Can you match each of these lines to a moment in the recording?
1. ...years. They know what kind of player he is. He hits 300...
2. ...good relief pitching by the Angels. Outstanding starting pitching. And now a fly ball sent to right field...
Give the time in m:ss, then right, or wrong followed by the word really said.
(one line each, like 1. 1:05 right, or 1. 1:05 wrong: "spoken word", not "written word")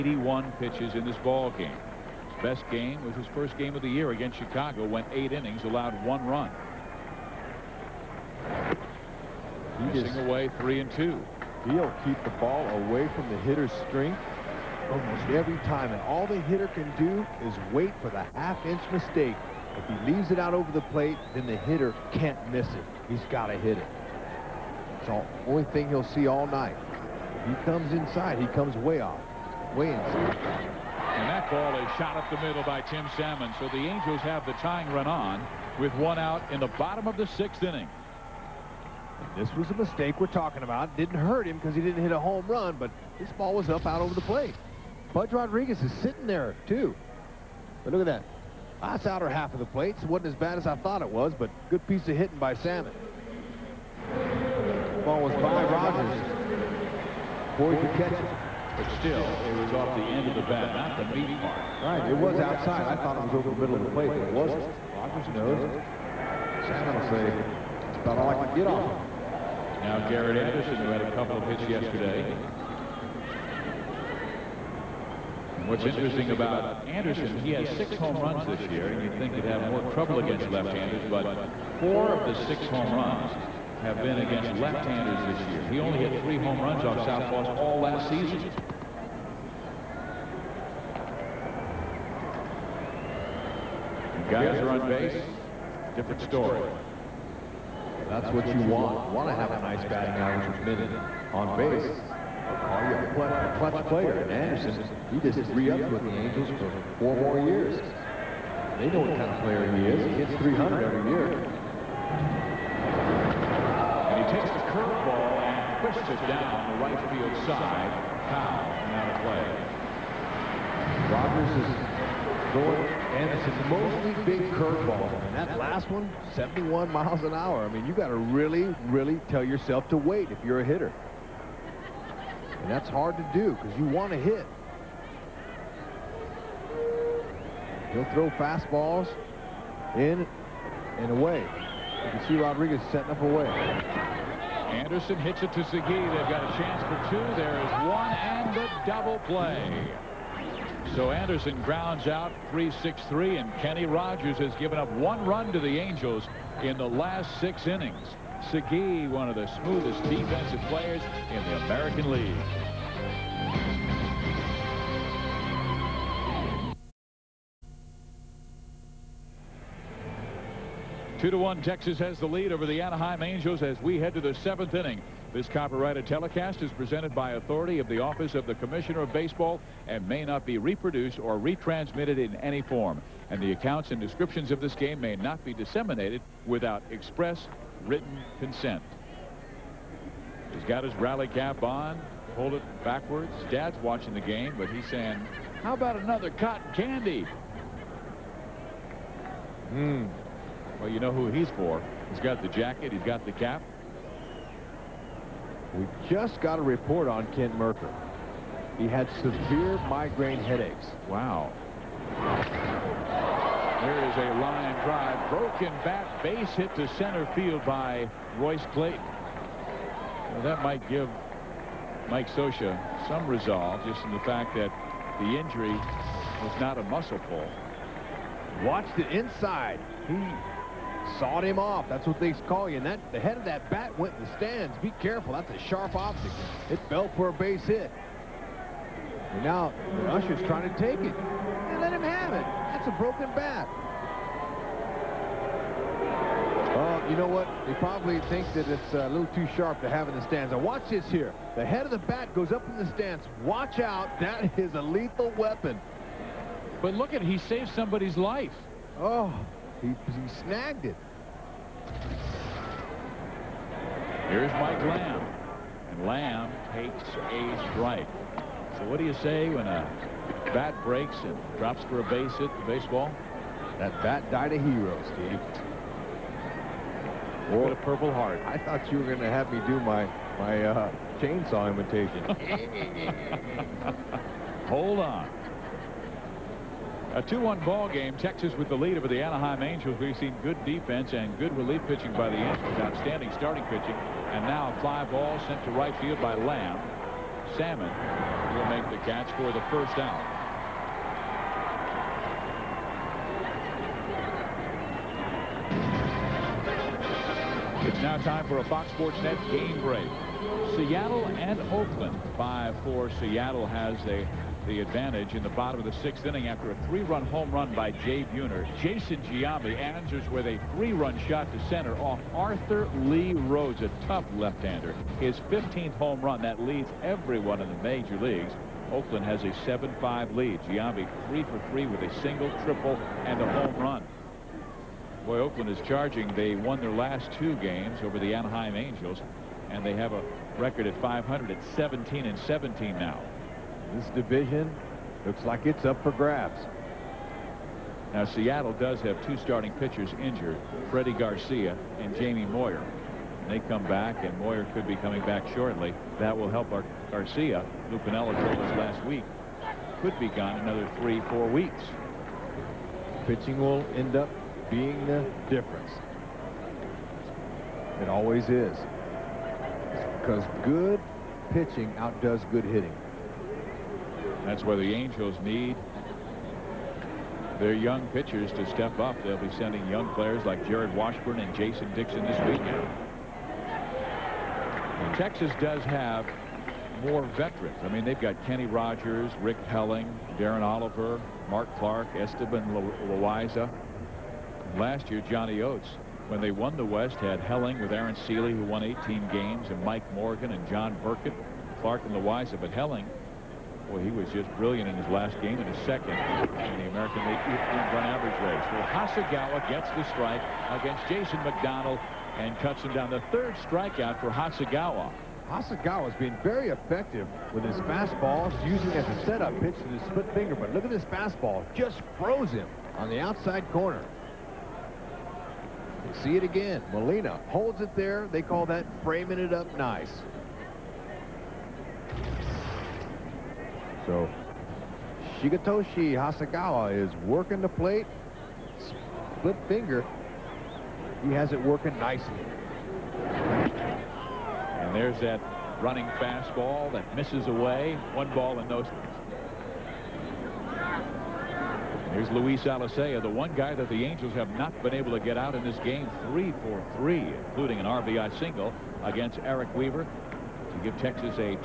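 1. 1:47 right
2. 4:51 right.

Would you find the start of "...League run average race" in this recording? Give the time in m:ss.
6:47.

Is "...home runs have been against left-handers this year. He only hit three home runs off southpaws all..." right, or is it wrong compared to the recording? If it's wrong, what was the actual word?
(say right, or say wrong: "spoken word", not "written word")
right.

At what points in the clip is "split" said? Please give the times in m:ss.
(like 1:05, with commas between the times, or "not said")
7:00, 7:19.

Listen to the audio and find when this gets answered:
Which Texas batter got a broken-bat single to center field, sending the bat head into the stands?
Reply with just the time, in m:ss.
3:38.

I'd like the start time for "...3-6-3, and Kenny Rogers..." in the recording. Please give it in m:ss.
2:32.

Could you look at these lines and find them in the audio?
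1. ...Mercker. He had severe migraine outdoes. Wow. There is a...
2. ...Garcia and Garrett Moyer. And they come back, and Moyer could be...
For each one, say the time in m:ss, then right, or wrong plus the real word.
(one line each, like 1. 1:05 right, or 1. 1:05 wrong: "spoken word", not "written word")
1. 3:27 wrong: "headaches", not "outdoes"
2. 5:51 wrong: "Jamie", not "Garrett".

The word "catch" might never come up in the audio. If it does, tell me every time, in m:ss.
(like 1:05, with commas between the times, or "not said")
0:57, 4:59.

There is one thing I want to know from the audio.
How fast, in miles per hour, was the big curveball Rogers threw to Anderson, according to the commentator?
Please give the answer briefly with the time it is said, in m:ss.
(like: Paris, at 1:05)
71, at 2:06.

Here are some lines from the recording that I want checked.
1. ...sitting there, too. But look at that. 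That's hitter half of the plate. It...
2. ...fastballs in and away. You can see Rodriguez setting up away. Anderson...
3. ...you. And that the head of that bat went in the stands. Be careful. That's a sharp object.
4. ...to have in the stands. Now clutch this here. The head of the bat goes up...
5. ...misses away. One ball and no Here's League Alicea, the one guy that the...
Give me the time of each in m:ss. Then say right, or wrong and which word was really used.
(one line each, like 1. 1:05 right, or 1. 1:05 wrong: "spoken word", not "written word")
1. 0:45 wrong: "outer", not "hitter"
2. 2:18 right
3. 3:52 right
4. 4:09 wrong: "watch", not "clutch"
5. 7:27 wrong: "Luis", not "League".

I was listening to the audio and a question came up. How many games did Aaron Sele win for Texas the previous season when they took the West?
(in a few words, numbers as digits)
18.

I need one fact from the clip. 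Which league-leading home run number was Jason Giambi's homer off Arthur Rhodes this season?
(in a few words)
15.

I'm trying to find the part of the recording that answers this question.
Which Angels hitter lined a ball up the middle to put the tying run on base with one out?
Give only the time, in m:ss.
0:32.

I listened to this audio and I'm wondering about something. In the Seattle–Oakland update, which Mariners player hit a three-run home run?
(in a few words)
Jay Buhner.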